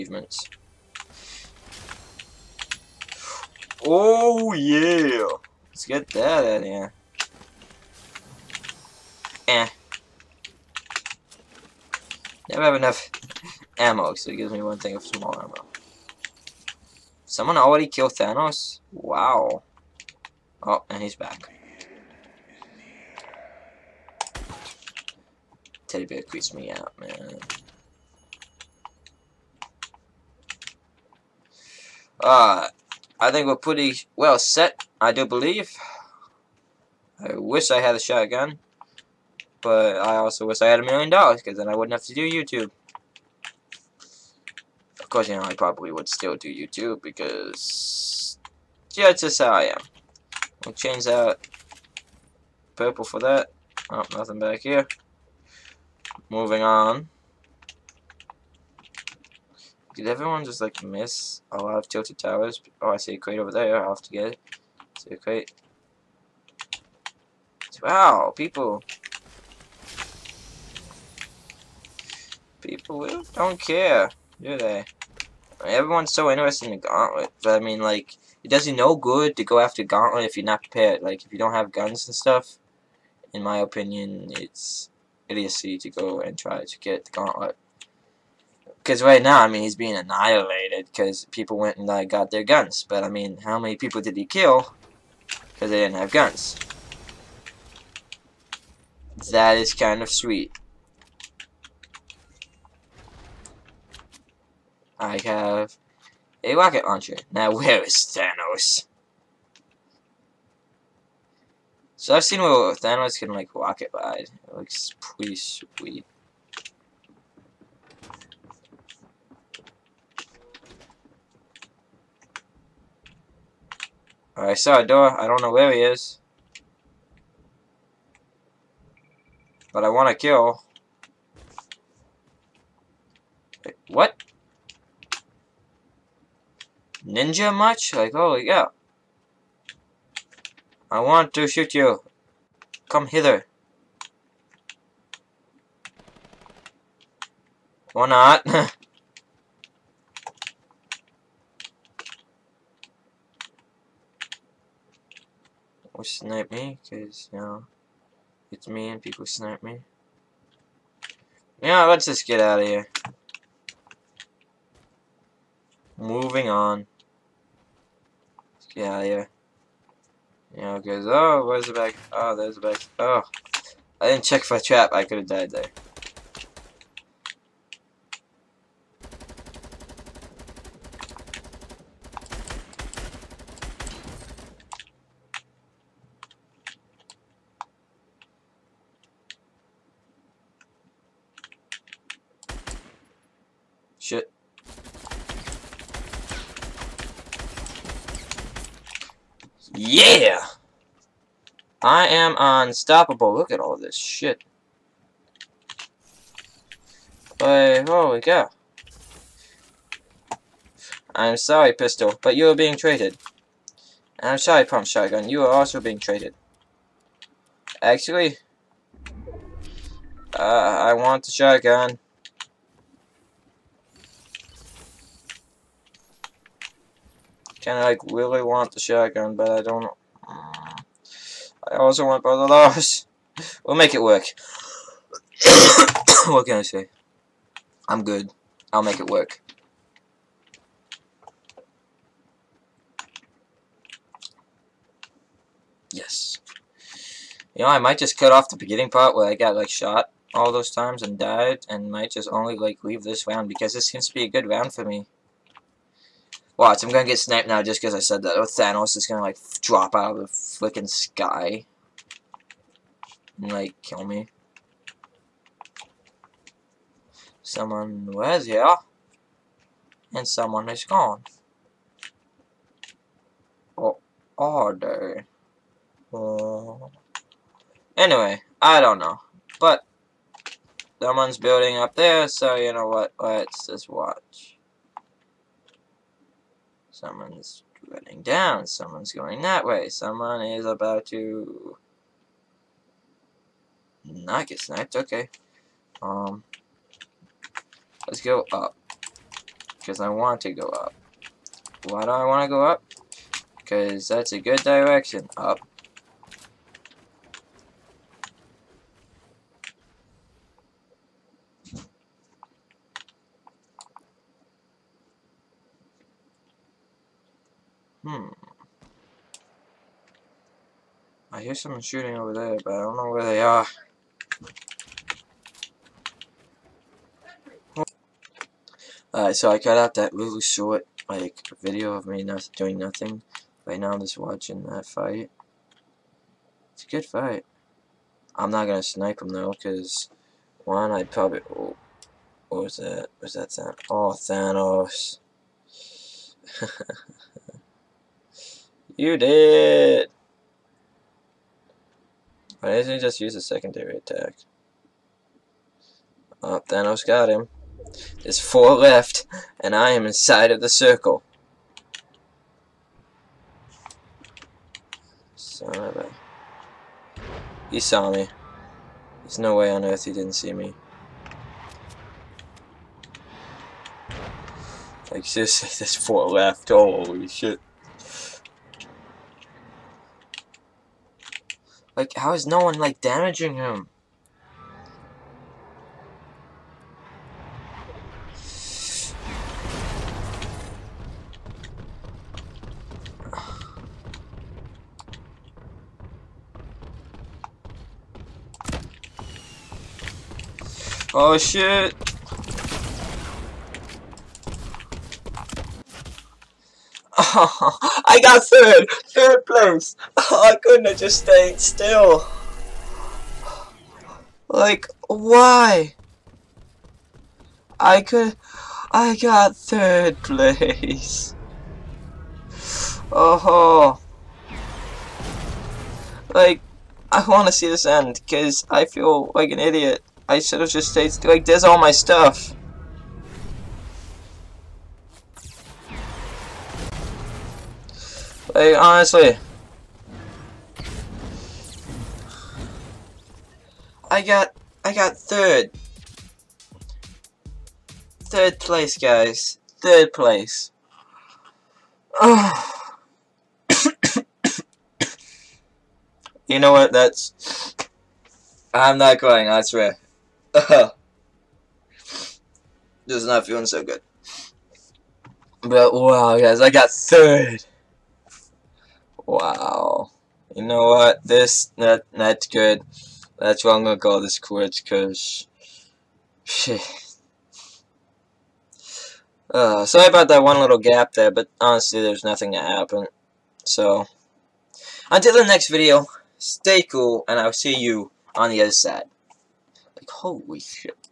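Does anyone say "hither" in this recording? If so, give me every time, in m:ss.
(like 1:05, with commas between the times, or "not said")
2:23.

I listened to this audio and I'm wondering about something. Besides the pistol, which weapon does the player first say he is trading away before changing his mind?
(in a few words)
Pump Shotgun.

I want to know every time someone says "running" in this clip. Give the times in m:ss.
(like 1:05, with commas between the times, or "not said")
4:47.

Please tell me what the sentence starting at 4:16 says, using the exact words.
Watch, I'm gonna get sniped now just because I said that.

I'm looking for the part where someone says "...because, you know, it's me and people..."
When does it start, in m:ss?
2:36.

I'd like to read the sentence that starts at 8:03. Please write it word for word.
So, until the next video, stay cool, and I'll see you on the other side.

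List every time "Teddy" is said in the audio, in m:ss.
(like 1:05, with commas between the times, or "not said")
0:25.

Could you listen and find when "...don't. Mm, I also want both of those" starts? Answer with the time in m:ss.
3:49.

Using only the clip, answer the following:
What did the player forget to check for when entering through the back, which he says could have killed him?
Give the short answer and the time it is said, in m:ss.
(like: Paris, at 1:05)
a trap, at 2:54.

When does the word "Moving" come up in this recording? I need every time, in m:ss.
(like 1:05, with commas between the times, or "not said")
0:56, 2:45.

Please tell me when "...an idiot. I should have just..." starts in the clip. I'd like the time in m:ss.
7:09.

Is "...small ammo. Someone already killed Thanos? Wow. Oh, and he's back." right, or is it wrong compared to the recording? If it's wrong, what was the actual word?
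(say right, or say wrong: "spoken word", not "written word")
right.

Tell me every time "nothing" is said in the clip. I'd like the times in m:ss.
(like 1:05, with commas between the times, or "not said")
0:54, 5:32, 8:02.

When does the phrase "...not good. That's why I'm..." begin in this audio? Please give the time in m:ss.
7:52.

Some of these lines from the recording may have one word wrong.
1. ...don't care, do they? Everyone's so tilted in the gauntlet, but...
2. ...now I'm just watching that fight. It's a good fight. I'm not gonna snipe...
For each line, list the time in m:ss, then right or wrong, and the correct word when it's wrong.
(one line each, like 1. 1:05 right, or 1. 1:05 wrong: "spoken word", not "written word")
1. 1:13 wrong: "interested", not "tilted"
2. 5:33 right.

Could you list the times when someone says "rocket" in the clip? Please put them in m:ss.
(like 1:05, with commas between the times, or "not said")
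1:46, 1:53.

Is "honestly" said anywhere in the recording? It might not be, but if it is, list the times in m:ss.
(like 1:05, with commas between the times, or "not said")
7:18, 8:01.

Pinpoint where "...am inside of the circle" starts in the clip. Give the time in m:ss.
5:59.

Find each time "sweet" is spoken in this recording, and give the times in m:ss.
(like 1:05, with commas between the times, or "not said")
1:40, 1:55.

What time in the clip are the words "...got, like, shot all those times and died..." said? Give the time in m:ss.
4:09.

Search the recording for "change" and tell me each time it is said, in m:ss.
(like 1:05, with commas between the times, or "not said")
0:50.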